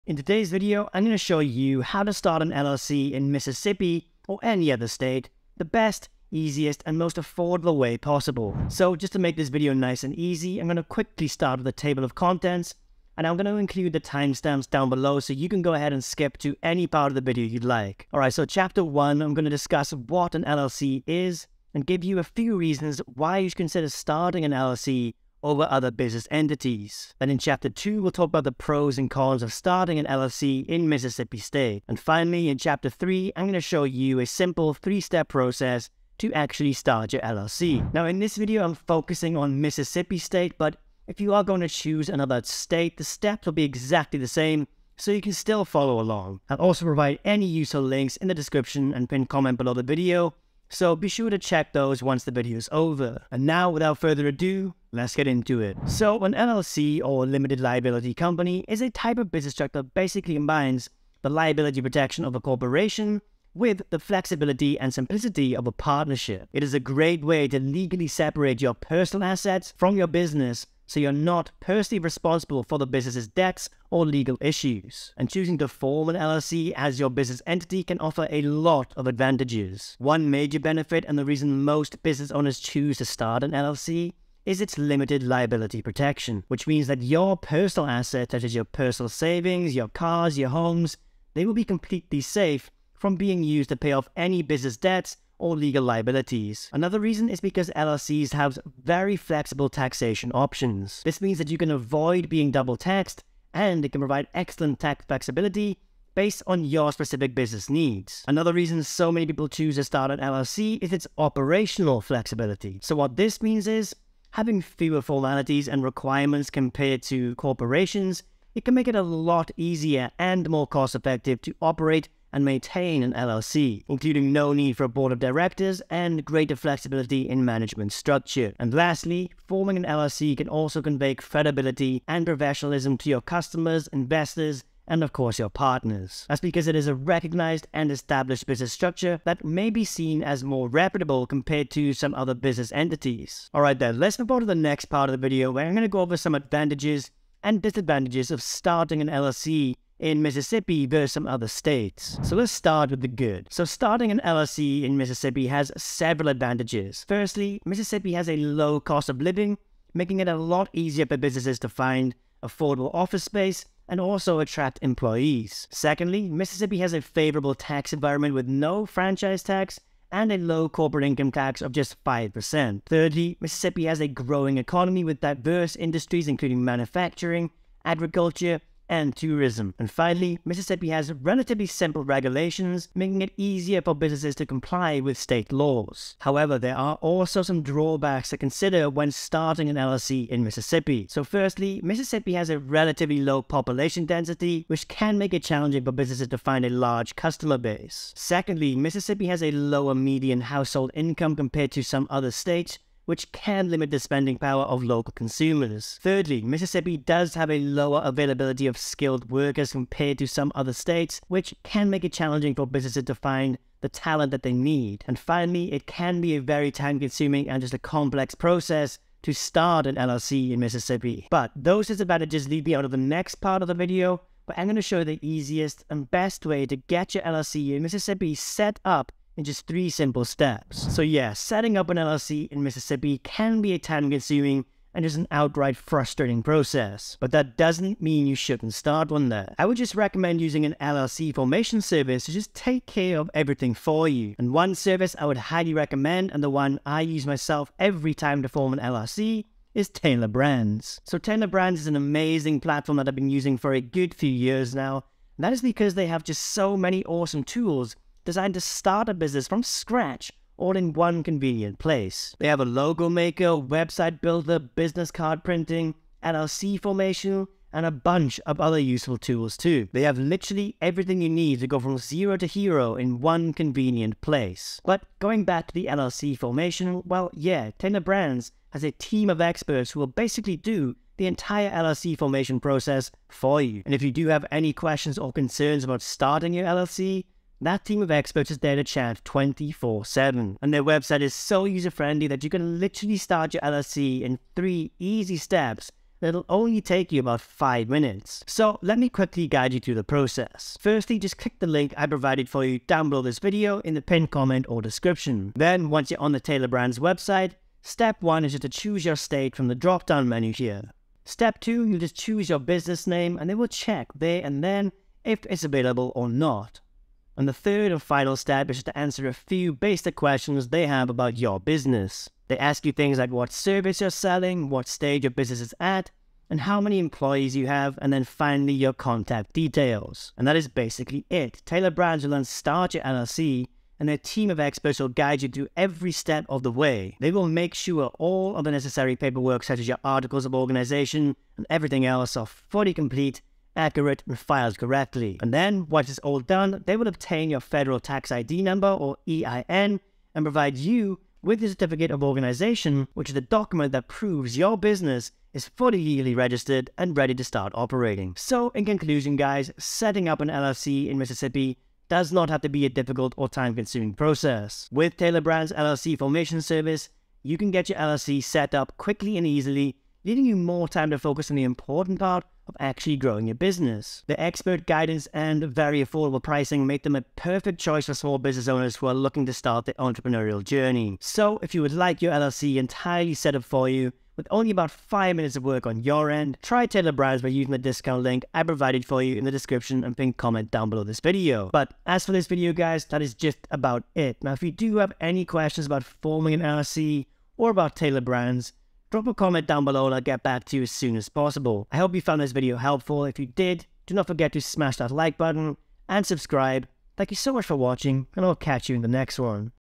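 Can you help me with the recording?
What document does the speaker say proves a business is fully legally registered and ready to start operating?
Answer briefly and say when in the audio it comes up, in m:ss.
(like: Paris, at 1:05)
Certificate of organization, at 5:51.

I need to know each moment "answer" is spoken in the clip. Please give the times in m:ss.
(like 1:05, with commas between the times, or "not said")
5:18.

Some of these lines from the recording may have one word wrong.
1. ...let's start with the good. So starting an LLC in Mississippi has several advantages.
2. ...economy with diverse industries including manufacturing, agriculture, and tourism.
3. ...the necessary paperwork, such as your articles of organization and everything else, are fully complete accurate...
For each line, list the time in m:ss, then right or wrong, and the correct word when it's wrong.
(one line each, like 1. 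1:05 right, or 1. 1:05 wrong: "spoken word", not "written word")
1. 2:32 right
2. 2:54 right
3. 5:38 right.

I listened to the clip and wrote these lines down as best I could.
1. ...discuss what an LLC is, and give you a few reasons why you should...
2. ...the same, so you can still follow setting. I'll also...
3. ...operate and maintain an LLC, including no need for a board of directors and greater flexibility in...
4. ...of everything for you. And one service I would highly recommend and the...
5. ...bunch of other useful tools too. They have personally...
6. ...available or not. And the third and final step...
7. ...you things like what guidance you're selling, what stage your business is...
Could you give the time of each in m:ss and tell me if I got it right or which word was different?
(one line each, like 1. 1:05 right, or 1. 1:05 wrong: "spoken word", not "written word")
1. 0:19 right
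2. 0:44 wrong: "along", not "setting"
3. 2:01 right
4. 4:03 right
5. 4:27 wrong: "literally", not "personally"
6. 5:15 right
7. 5:22 wrong: "service", not "guidance".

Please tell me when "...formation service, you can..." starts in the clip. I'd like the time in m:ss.
6:06.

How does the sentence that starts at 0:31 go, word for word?
And finally, in chapter 3, I'm going to show you a simple three-step process to actually start your LLC.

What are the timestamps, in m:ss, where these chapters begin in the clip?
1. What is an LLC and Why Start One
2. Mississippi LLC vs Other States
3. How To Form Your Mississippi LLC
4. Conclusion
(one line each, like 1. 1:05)
1. 0:54
2. 2:23
3. 3:48
4. 6:09.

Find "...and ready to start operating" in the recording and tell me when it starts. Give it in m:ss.
5:56.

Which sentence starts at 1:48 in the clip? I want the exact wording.
Another reason so many people choose to start an LLC is its operational flexibility.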